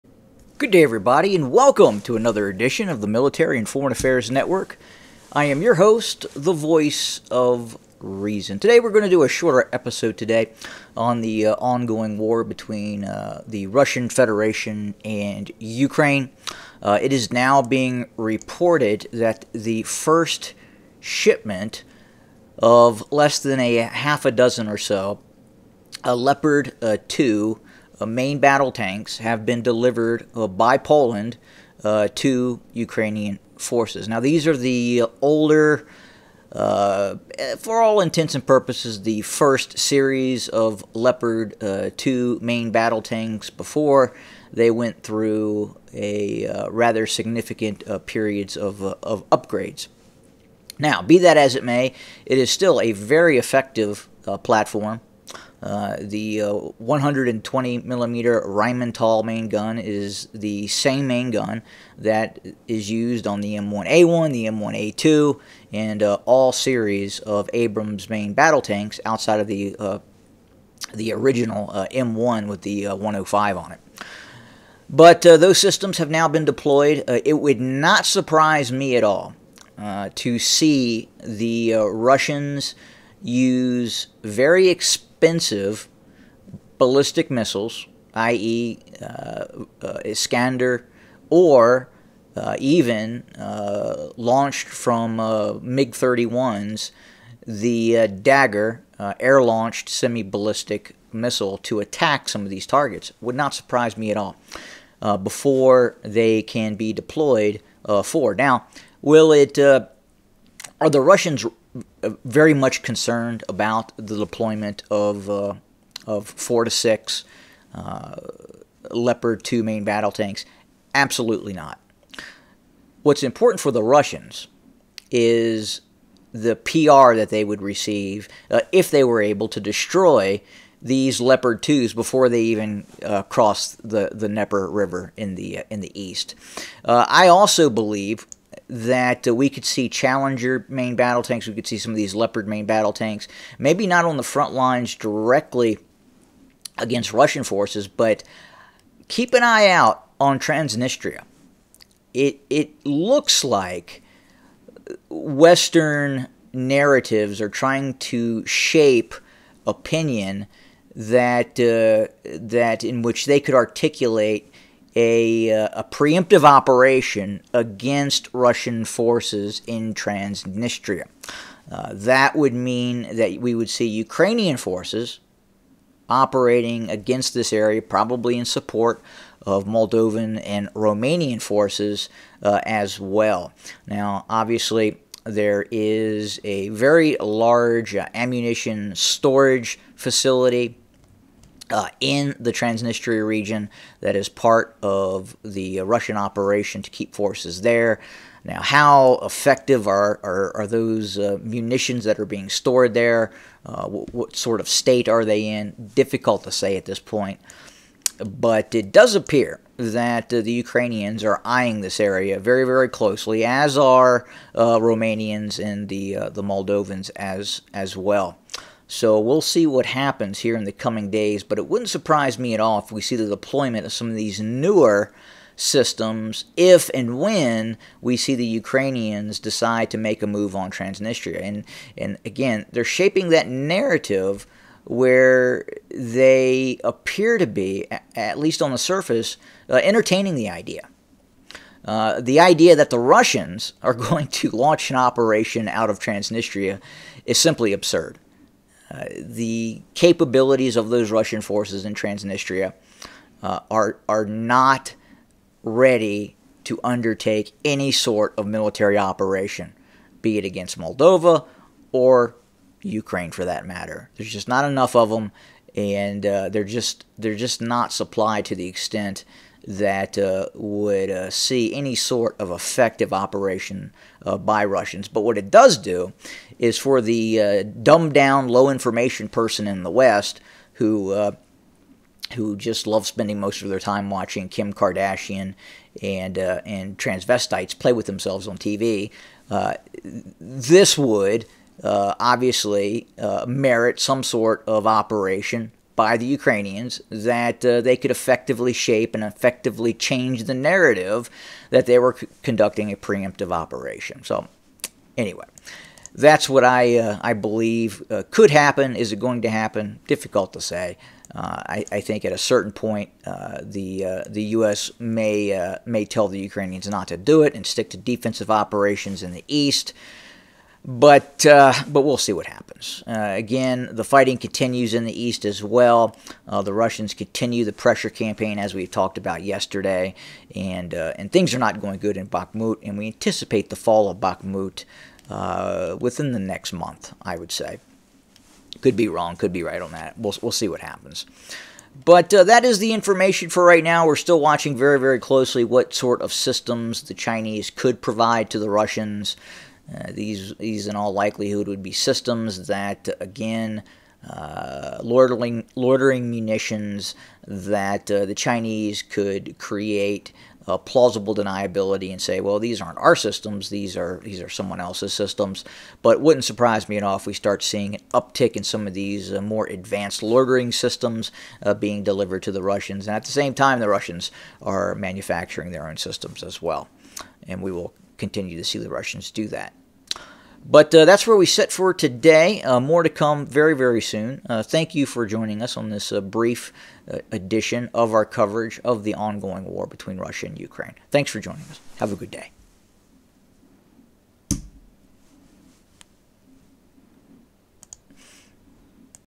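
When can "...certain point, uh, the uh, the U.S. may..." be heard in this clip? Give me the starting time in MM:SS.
05:12.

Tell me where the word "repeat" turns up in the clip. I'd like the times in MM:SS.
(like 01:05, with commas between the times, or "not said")
not said.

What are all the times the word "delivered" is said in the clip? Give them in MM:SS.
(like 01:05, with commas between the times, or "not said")
00:29, 06:12.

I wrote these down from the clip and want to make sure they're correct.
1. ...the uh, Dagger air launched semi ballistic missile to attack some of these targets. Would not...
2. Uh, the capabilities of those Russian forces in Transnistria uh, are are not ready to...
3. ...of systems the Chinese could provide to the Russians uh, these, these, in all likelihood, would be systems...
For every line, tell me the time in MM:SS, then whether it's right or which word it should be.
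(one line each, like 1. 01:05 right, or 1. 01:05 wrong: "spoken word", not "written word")
1. 01:37 right
2. 04:08 right
3. 05:46 right.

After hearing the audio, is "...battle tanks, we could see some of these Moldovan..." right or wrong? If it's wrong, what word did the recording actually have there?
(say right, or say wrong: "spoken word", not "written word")
wrong: "Leopard", not "Moldovan".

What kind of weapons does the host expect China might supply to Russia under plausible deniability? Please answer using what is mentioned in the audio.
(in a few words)
loitering munitions.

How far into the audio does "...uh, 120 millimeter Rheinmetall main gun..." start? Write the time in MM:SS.
00:56.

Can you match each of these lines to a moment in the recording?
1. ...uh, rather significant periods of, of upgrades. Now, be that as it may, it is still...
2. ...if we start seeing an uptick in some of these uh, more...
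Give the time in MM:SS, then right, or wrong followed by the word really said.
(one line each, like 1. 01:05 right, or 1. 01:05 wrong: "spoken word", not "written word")
1. 00:46 right
2. 06:07 right.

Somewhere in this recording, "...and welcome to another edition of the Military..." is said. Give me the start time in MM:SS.
00:01.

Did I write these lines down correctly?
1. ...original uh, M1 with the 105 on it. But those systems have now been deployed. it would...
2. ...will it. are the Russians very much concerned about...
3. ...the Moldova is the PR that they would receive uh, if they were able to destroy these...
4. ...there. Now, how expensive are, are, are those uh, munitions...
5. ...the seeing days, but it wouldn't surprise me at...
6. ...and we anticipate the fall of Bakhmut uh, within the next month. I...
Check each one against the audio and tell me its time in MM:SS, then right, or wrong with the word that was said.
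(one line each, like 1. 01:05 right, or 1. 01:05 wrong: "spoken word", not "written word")
1. 01:11 right
2. 01:49 right
3. 02:03 wrong: "Russians", not "Moldova"
4. 03:17 wrong: "effective", not "expensive"
5. 03:40 wrong: "coming", not "seeing"
6. 05:32 right.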